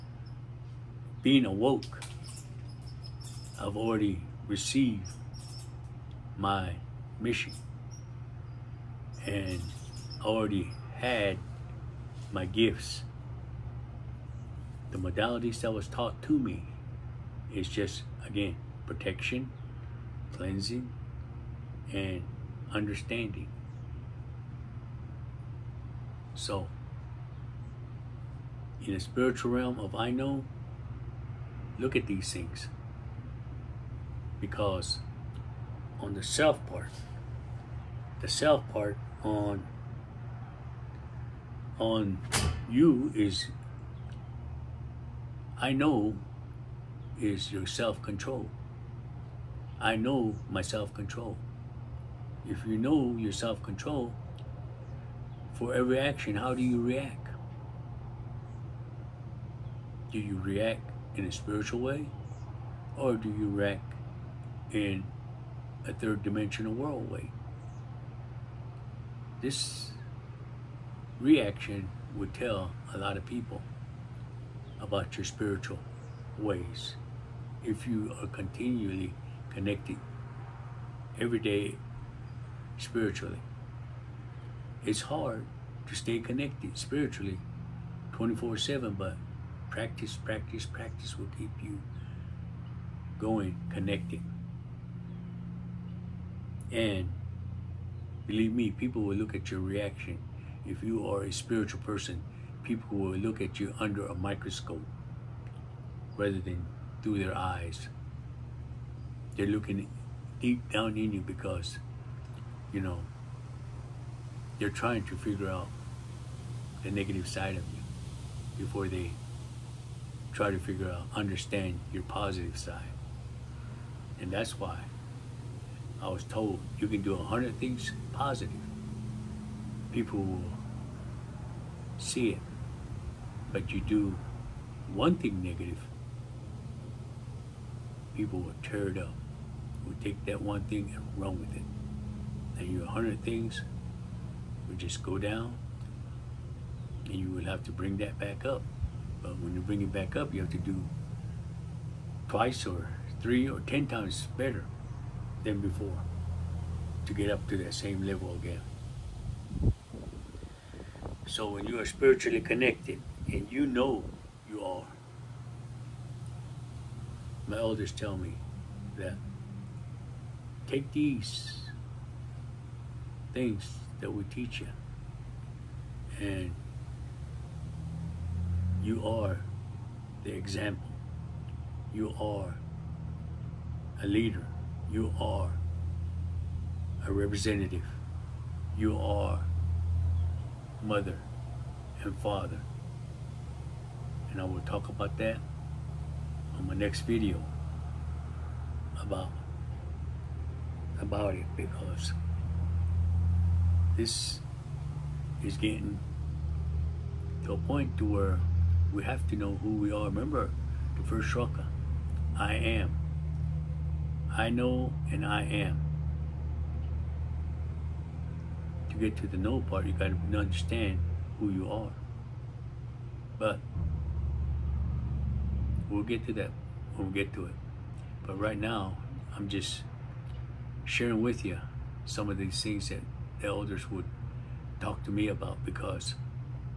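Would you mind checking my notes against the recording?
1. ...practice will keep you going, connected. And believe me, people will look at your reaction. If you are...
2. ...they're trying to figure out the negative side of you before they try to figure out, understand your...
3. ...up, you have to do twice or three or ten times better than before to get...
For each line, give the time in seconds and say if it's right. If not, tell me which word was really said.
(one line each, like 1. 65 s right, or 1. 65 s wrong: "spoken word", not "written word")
1. 90 s right
2. 114 s right
3. 150 s right.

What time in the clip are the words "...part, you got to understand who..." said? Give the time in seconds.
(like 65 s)
219 s.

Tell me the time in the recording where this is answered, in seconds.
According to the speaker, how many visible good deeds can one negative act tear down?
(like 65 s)
127 s.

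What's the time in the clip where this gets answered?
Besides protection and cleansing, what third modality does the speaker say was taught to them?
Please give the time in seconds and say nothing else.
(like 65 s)
22 s.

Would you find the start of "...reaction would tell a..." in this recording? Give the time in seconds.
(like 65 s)
71 s.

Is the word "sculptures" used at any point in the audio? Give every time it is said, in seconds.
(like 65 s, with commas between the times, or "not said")
not said.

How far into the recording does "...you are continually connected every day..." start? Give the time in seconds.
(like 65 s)
77 s.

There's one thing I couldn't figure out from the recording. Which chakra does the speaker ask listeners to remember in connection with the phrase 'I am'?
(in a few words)
The first chakra.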